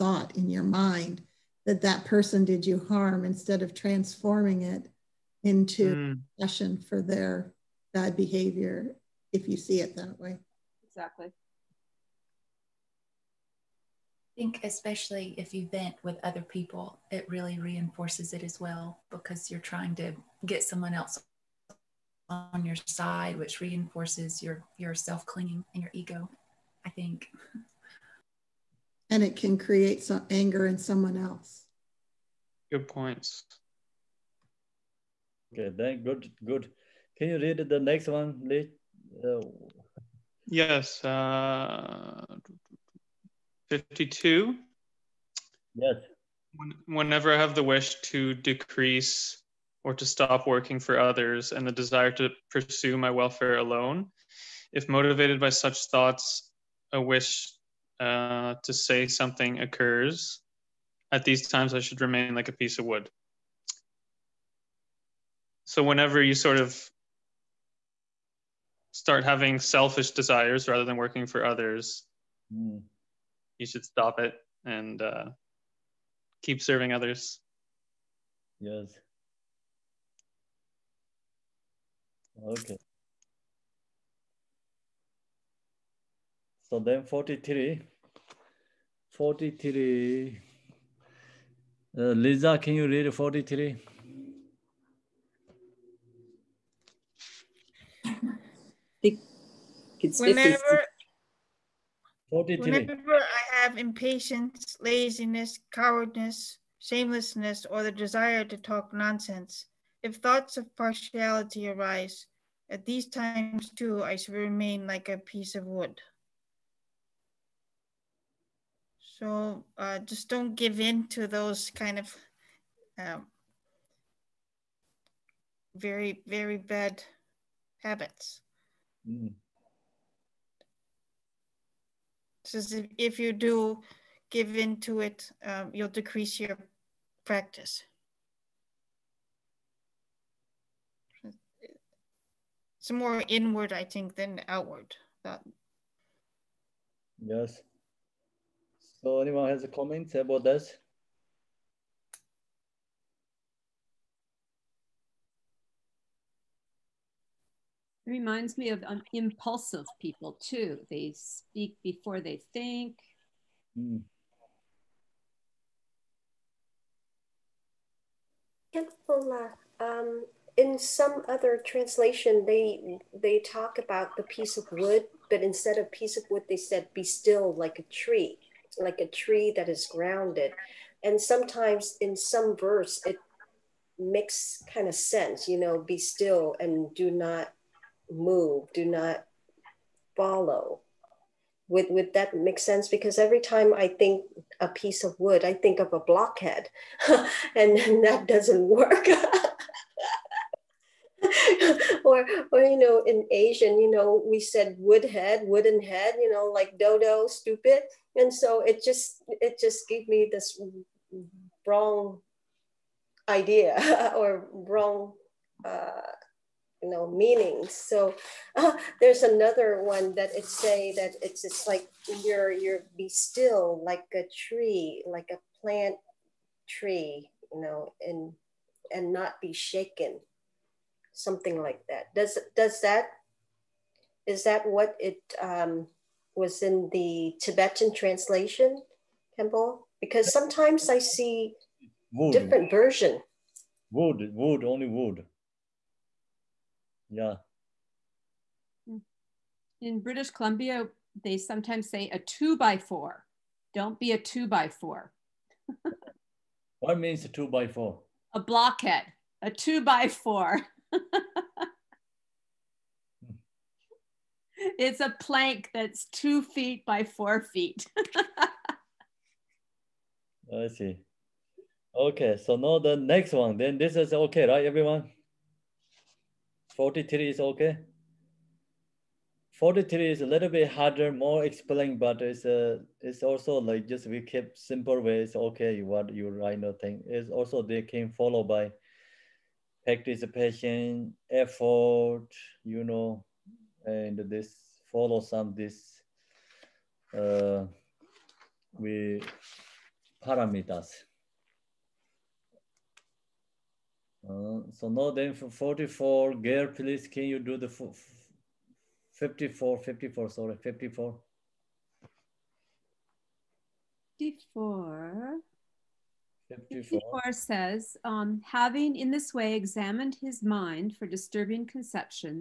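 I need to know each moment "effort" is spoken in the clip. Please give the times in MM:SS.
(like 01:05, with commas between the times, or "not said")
04:51.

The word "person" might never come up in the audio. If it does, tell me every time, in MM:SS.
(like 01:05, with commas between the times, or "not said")
00:02.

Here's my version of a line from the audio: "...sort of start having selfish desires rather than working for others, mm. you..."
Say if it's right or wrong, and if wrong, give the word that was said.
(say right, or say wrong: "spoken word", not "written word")
right.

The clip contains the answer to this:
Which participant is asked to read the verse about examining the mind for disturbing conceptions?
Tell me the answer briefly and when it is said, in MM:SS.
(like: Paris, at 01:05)
Gail, at 05:06.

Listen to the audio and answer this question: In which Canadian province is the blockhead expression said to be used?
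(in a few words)
British Columbia.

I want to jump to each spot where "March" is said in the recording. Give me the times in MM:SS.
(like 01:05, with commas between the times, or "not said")
not said.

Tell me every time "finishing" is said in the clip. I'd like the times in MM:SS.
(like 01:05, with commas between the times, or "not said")
not said.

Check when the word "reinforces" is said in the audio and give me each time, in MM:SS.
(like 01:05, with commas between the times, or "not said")
00:17, 00:23.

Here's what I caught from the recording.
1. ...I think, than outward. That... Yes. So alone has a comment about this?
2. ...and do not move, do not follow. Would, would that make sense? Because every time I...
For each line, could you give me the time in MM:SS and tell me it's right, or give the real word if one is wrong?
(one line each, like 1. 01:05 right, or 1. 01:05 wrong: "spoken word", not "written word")
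1. 02:23 wrong: "anyone", not "alone"
2. 03:06 right.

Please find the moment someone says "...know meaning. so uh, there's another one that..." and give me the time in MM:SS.
03:36.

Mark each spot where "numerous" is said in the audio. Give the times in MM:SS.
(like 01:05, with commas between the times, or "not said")
not said.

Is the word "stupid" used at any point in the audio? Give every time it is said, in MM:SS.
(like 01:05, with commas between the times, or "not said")
03:27.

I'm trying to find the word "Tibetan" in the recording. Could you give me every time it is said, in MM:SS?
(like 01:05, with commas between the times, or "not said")
03:57.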